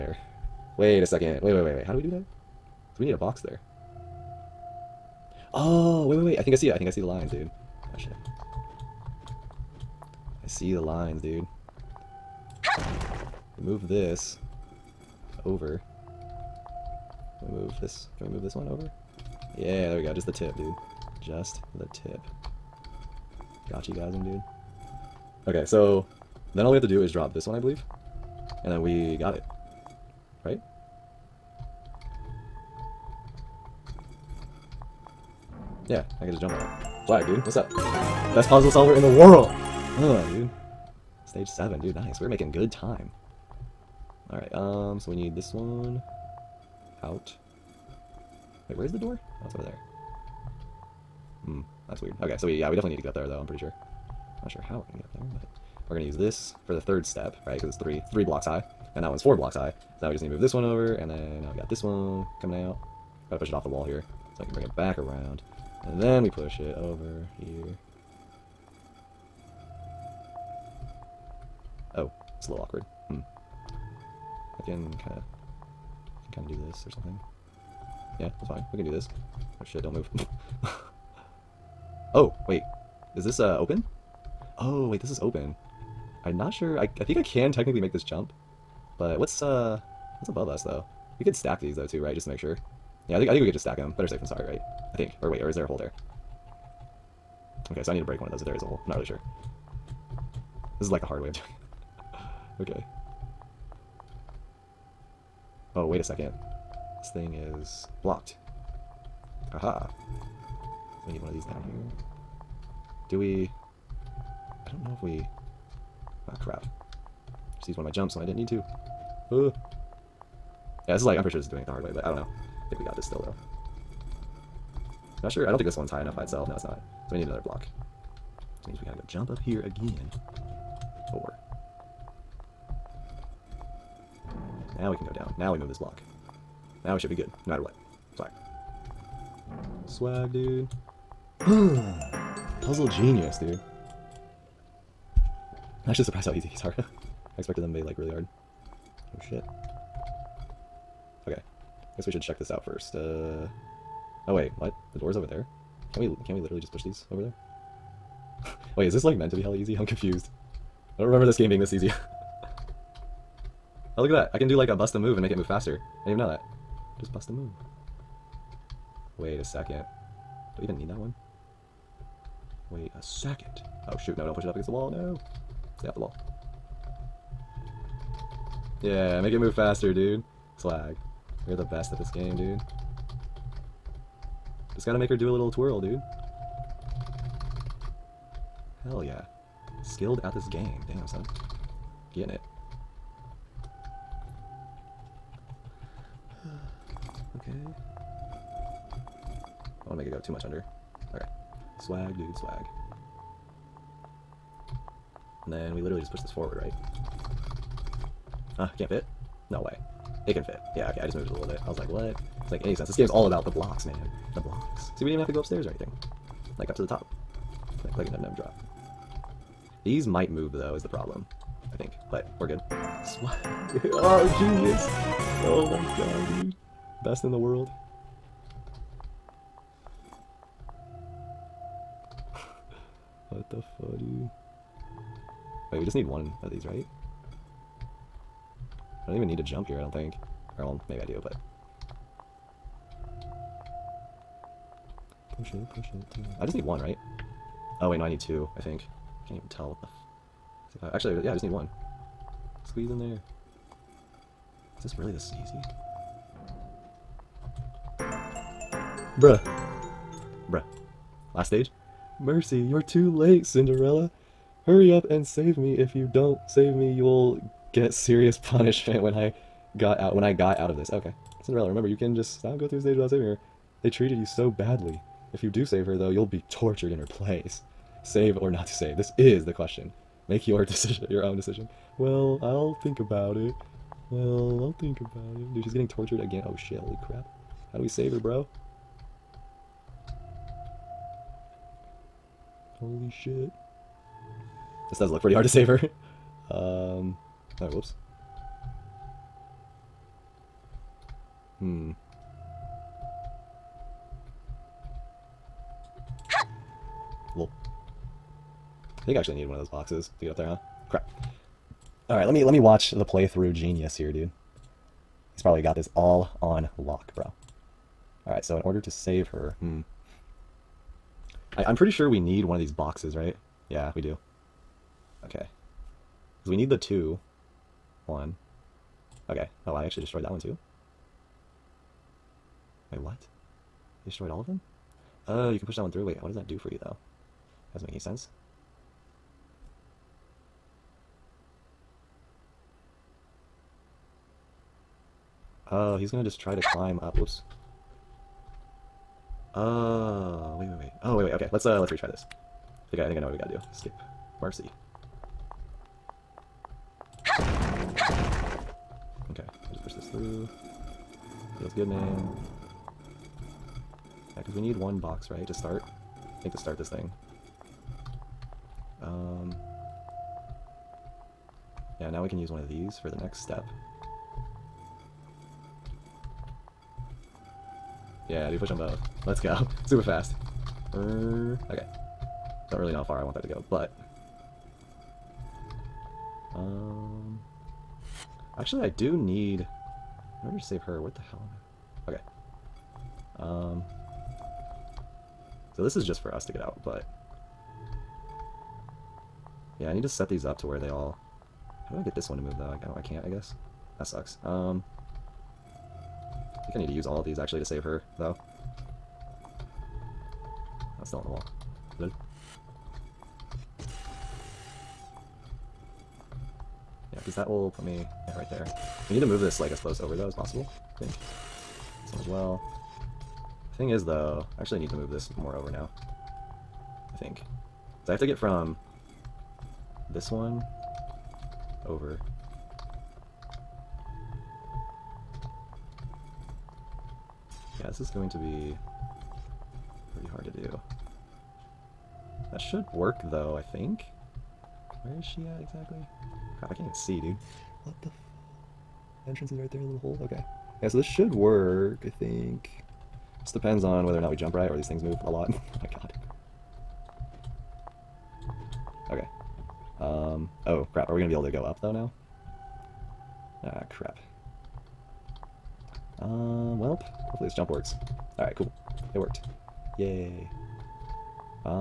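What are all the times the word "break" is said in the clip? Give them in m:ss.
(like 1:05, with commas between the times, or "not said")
1:38.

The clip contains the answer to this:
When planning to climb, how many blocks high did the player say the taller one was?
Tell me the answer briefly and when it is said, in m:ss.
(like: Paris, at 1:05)
4, at 0:59.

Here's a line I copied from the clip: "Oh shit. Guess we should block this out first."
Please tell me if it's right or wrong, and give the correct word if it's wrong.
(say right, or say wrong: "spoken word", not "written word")
wrong: "check", not "block".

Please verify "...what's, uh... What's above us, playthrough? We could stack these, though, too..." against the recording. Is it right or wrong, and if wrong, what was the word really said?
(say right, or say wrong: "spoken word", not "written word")
wrong: "though", not "playthrough".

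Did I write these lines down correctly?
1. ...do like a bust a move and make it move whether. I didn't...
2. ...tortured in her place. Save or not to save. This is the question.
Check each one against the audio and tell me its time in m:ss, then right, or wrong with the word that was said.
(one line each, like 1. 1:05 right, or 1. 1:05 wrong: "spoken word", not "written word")
1. 2:44 wrong: "faster", not "whether"
2. 4:36 right.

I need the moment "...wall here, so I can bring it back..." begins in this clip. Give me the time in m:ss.
1:03.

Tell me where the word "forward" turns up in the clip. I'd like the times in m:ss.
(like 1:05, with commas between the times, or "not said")
3:26.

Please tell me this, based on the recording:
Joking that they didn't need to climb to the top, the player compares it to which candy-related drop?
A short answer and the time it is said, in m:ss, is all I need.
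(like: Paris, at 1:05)
M&M drop, at 3:38.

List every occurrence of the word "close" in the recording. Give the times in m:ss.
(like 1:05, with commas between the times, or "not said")
6:59.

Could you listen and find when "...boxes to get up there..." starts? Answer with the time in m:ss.
5:09.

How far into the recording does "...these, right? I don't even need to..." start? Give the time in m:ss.
3:56.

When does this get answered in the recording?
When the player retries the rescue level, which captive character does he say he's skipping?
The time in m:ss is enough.
5:54.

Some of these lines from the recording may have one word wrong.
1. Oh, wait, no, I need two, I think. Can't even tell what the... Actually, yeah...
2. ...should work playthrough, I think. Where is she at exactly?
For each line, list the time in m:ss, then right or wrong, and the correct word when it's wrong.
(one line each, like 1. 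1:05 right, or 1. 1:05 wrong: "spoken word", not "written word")
1. 4:07 right
2. 7:22 wrong: "though", not "playthrough".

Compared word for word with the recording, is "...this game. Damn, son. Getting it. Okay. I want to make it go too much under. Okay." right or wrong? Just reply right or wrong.
right.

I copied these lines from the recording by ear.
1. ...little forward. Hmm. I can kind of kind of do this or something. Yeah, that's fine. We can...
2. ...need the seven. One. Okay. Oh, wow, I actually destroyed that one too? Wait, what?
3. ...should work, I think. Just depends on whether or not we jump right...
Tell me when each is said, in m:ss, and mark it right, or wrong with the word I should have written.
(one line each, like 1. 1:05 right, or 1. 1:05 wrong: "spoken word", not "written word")
1. 1:12 wrong: "awkward", not "forward"
2. 5:26 wrong: "two", not "seven"
3. 7:31 right.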